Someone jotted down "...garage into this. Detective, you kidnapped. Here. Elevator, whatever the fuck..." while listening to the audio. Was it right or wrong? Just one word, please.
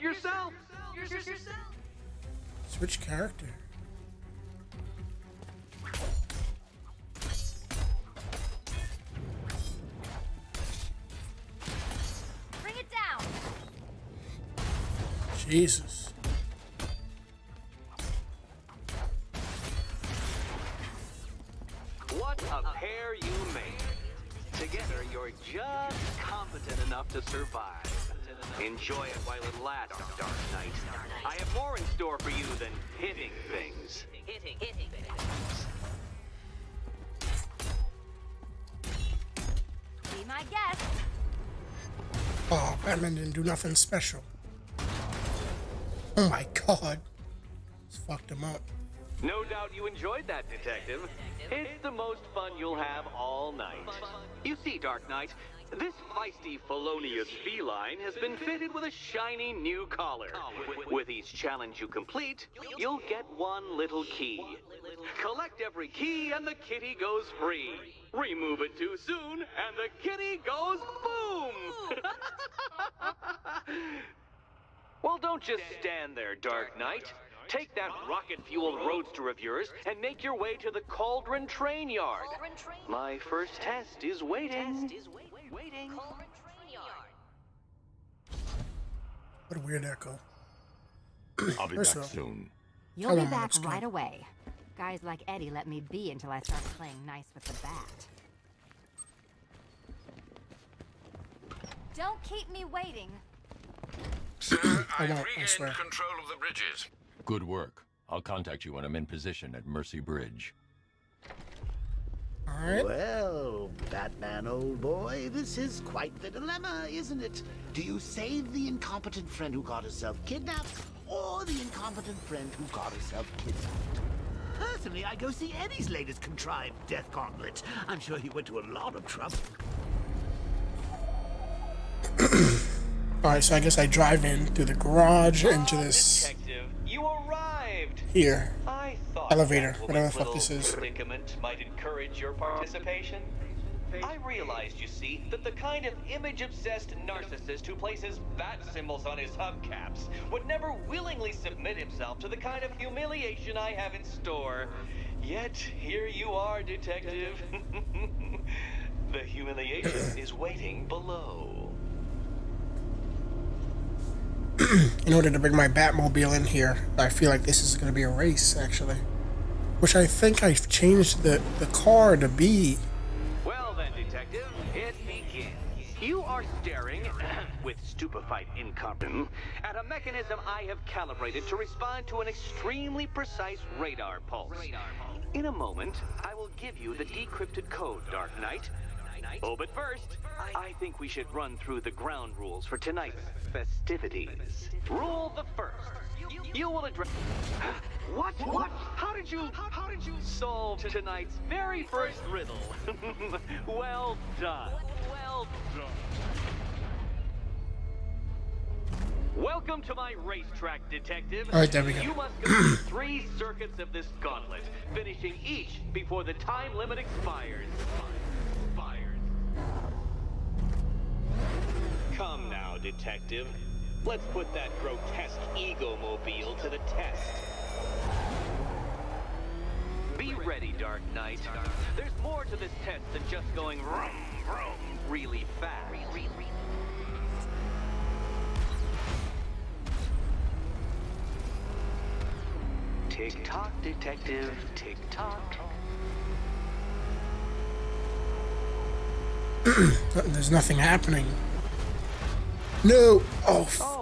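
wrong.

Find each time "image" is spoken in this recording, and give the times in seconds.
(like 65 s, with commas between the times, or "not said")
146 s.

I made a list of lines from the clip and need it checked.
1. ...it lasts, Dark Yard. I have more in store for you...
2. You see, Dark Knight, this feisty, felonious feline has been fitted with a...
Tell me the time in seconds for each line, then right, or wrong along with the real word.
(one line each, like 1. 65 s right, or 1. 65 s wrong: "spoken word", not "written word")
1. 29 s wrong: "Knight", not "Yard"
2. 54 s right.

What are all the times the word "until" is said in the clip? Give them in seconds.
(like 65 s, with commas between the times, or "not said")
96 s.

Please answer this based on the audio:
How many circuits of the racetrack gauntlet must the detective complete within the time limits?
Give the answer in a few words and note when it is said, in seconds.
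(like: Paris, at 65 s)
3, at 212 s.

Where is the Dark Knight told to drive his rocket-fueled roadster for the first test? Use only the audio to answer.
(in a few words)
Cauldron Train Yard.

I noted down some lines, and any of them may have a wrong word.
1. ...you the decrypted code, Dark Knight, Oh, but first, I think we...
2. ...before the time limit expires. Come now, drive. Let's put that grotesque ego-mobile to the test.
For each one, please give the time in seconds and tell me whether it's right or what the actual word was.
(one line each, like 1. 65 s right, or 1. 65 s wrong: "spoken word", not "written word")
1. 186 s right
2. 215 s wrong: "detective", not "drive".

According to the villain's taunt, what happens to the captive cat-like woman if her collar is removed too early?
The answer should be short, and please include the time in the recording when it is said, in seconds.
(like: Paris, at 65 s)
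goes boom, at 70 s.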